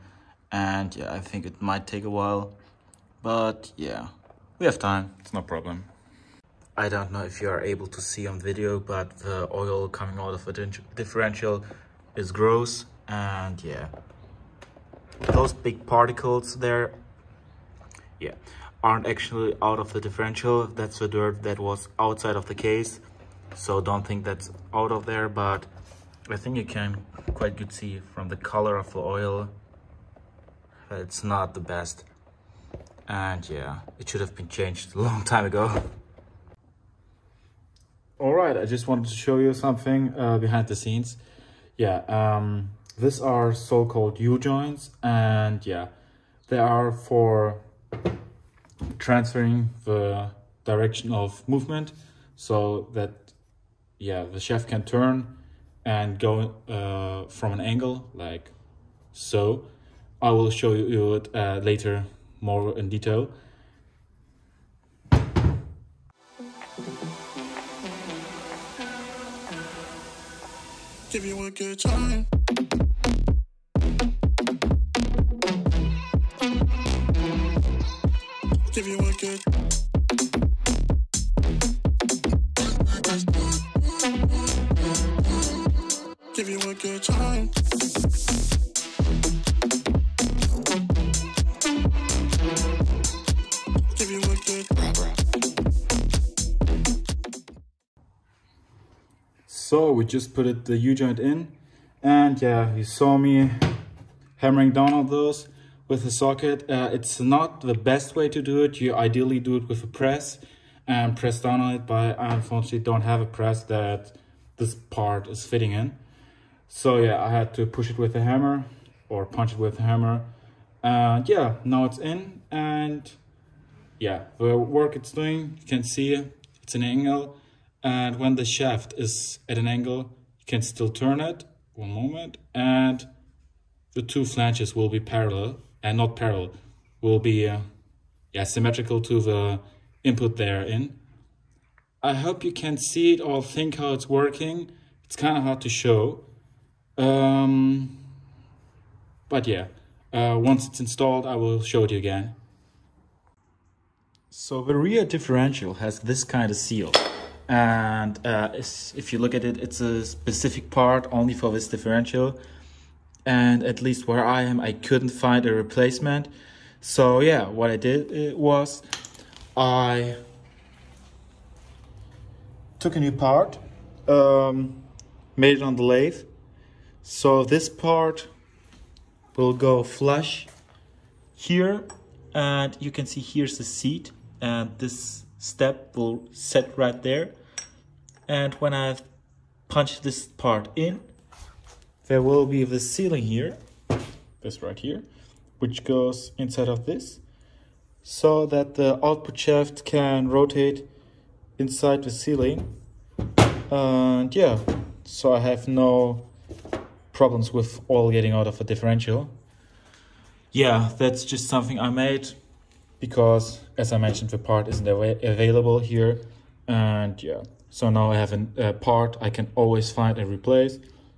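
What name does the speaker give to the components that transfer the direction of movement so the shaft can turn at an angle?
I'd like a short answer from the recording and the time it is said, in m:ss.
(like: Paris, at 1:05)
U-joints, at 0:44.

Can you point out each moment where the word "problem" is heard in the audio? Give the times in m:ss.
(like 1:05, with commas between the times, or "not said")
0:05, 3:27.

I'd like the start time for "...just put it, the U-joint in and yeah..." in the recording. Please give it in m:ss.
1:40.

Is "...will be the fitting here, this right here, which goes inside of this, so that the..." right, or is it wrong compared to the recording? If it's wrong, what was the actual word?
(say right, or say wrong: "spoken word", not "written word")
wrong: "sealing", not "fitting".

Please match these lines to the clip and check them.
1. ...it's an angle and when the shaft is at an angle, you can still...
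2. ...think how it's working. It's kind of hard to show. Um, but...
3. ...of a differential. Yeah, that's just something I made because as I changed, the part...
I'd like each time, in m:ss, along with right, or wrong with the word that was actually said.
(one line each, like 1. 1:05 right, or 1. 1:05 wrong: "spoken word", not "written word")
1. 2:06 right
2. 2:23 right
3. 3:28 wrong: "mentioned", not "changed".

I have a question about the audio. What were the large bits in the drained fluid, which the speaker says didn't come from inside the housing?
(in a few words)
dirt.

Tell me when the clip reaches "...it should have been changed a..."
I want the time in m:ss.
0:33.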